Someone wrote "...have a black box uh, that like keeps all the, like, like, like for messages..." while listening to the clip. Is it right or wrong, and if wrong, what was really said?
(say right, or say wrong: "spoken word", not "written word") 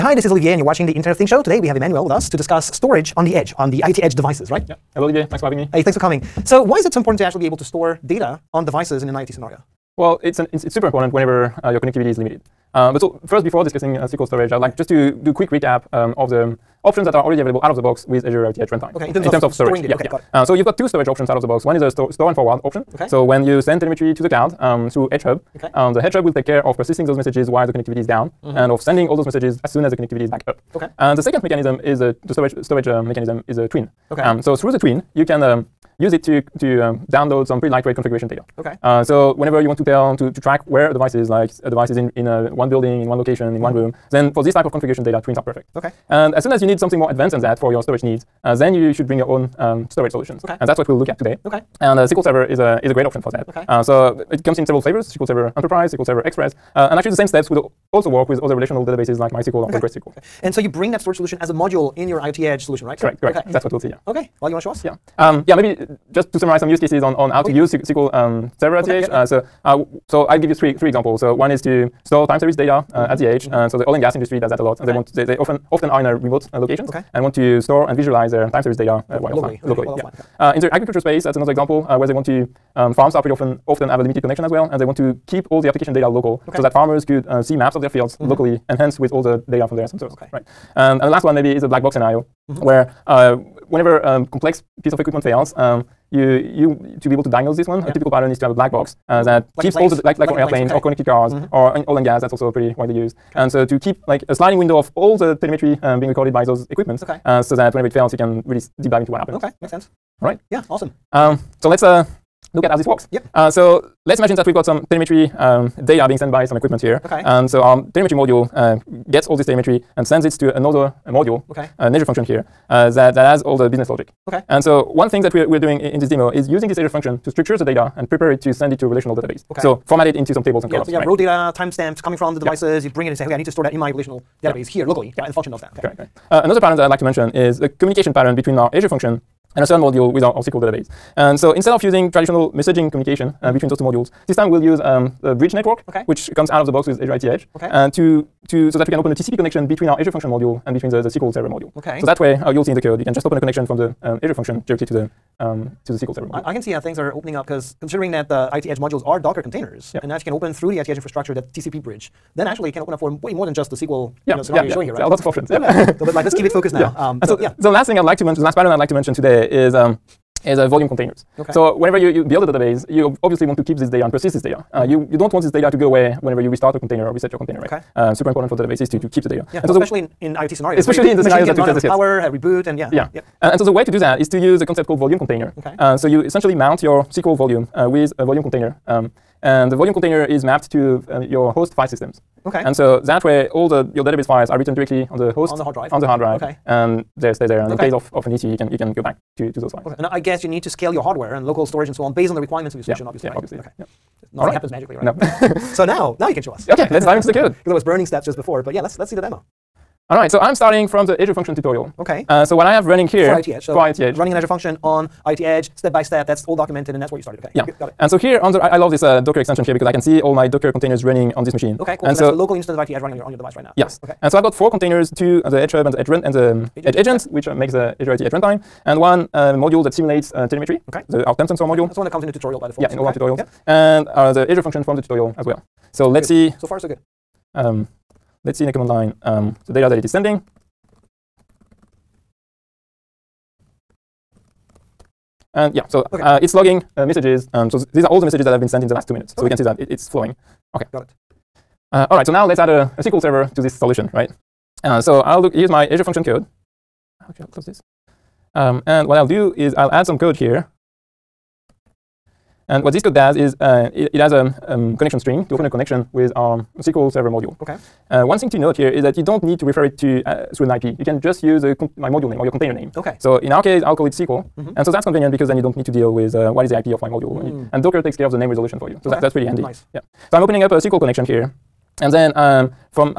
wrong: "airplanes", not "messages".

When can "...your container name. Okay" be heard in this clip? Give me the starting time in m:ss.
4:32.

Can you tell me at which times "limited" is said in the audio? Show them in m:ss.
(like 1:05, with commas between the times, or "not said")
0:12, 1:24.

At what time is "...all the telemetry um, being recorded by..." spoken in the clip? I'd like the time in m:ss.
1:44.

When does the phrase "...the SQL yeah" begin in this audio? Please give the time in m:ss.
2:43.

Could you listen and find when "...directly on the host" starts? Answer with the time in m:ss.
3:14.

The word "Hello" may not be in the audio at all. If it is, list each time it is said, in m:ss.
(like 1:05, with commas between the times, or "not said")
0:04.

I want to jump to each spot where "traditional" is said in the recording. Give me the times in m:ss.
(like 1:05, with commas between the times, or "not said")
2:22.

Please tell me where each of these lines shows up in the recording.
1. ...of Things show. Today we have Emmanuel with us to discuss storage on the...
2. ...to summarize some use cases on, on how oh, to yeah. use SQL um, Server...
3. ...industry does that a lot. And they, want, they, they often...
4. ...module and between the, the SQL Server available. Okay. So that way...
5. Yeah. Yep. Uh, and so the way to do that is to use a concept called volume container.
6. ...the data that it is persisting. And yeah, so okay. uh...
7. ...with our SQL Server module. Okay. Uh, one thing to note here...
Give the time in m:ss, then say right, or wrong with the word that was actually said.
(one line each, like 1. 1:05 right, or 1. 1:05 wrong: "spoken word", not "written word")
1. 0:01 right
2. 1:06 right
3. 1:14 right
4. 2:30 wrong: "module", not "available"
5. 3:02 right
6. 3:59 wrong: "sending", not "persisting"
7. 4:26 right.